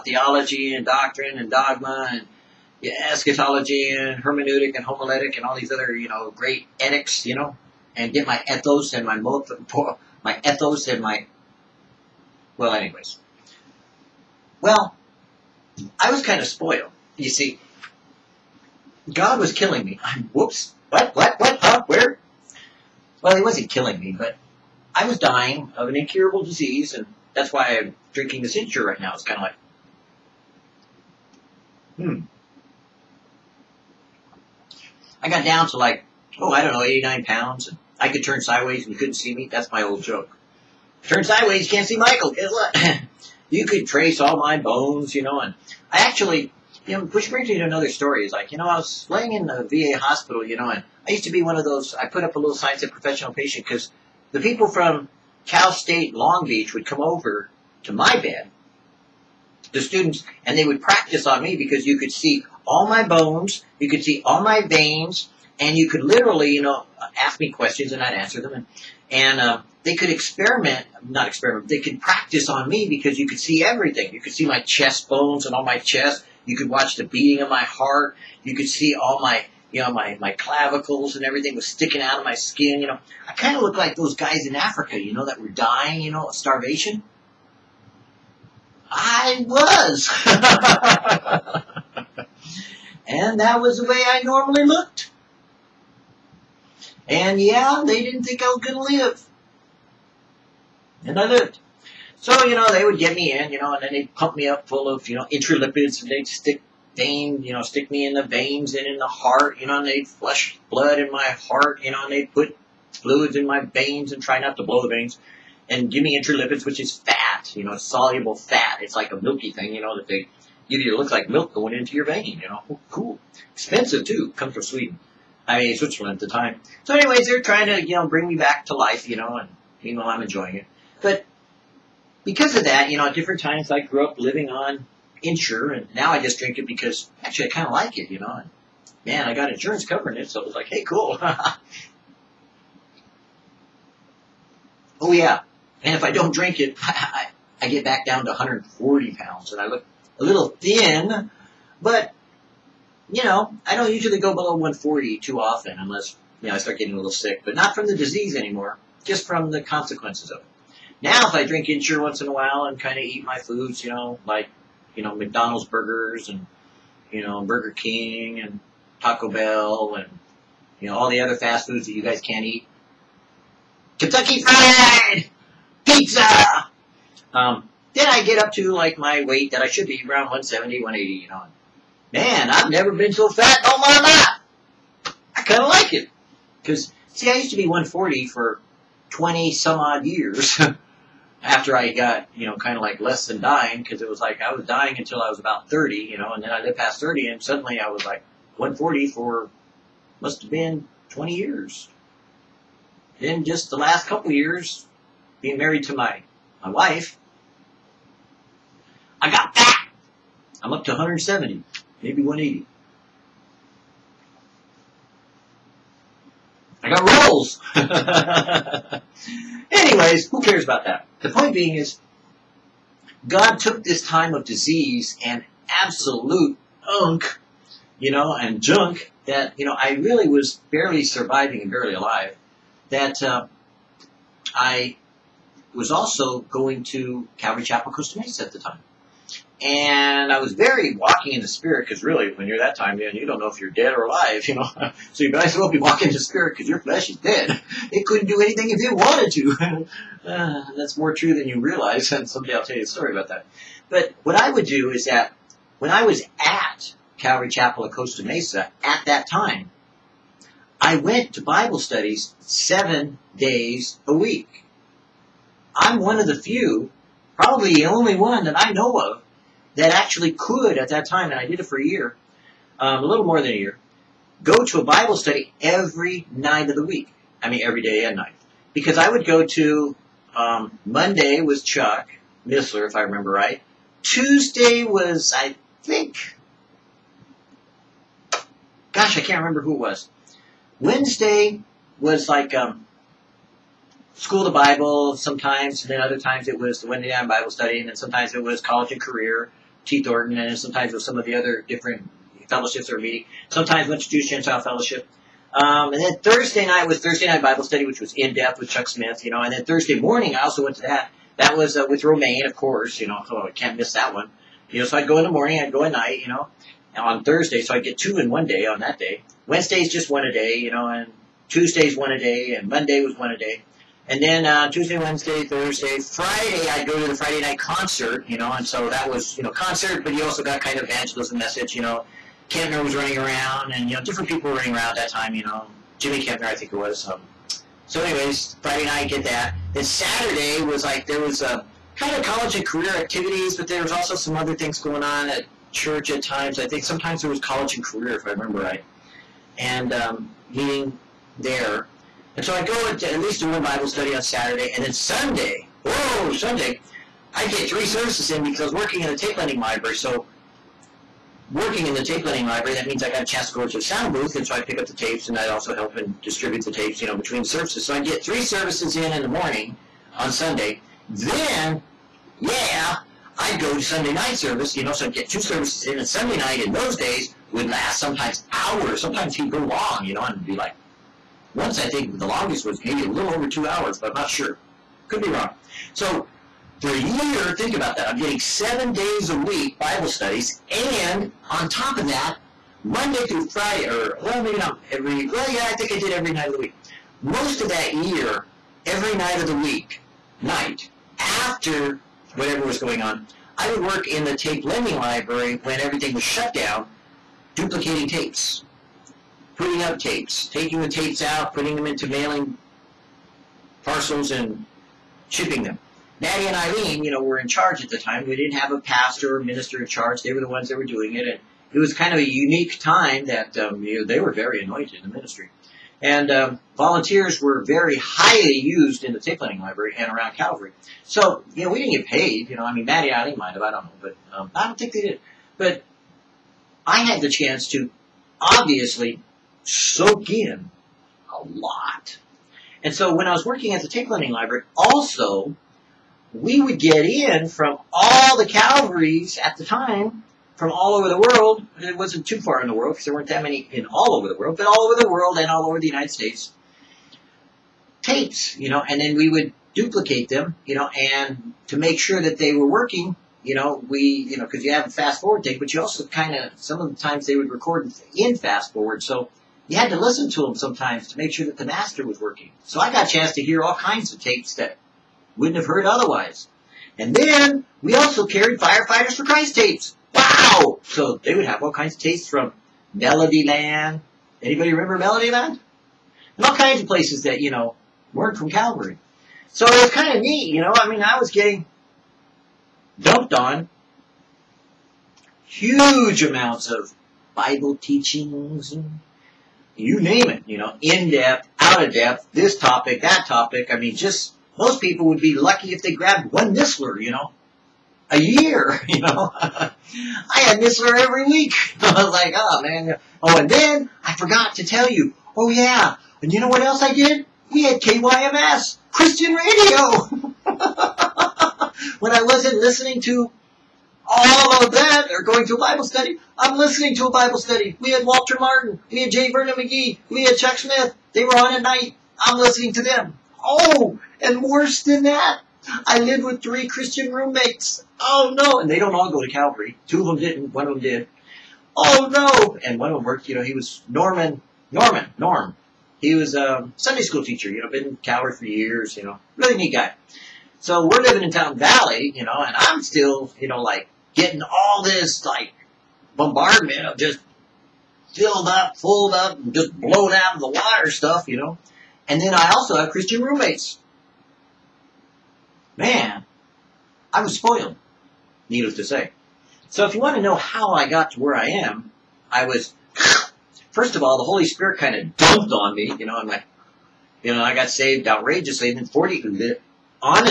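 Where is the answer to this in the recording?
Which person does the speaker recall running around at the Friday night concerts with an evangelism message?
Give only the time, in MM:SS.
05:35.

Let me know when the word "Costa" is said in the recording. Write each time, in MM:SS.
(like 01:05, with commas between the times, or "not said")
03:57, 04:17.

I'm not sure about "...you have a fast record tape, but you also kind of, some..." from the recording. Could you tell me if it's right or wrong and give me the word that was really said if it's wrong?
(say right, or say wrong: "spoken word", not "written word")
wrong: "forward", not "record".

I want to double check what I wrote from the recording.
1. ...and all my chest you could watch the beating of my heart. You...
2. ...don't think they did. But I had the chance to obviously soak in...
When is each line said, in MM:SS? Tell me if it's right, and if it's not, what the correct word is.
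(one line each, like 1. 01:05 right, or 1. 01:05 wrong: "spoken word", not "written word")
1. 01:15 right
2. 07:14 right.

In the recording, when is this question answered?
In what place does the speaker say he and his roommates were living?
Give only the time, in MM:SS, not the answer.
09:11.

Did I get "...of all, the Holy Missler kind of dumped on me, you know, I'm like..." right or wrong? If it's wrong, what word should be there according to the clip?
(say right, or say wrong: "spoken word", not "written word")
wrong: "Spirit", not "Missler".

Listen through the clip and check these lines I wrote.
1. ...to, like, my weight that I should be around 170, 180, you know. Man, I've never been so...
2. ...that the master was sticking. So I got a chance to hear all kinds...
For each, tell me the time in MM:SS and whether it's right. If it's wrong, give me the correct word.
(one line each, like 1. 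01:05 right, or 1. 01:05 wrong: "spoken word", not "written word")
1. 02:58 right
2. 07:51 wrong: "working", not "sticking".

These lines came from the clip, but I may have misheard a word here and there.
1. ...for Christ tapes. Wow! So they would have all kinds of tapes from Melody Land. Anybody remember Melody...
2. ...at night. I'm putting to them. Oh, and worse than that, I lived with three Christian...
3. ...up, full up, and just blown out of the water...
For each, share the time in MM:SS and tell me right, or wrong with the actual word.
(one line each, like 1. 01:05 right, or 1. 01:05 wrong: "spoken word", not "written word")
1. 07:59 right
2. 08:51 wrong: "listening", not "putting"
3. 09:18 right.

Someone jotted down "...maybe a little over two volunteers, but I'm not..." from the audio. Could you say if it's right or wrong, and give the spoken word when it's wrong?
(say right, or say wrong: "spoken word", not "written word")
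wrong: "hours", not "volunteers".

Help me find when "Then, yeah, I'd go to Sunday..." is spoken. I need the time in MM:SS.
06:11.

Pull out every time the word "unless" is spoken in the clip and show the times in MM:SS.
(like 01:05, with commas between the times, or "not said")
02:35.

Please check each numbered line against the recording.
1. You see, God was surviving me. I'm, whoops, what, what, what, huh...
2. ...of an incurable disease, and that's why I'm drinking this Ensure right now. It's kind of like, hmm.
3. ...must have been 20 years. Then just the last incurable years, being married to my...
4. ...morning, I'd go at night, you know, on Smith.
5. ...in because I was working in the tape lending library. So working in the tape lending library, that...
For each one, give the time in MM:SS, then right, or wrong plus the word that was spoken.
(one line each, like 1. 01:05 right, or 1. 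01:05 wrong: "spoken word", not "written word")
1. 00:17 wrong: "killing", not "surviving"
2. 00:25 right
3. 03:20 wrong: "couple", not "incurable"
4. 05:15 wrong: "Thursday", not "Smith"
5. 05:58 right.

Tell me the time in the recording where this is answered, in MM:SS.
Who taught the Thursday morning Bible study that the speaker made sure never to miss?
05:12.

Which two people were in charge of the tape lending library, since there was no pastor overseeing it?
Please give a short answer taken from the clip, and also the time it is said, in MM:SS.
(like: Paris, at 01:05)
Natty and Eileen, at 06:56.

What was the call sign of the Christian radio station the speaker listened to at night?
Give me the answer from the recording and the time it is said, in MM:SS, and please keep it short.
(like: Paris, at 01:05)
KYMS, at 08:37.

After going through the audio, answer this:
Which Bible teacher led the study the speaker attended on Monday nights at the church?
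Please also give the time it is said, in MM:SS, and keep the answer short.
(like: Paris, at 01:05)
Chuck Missler, at 04:41.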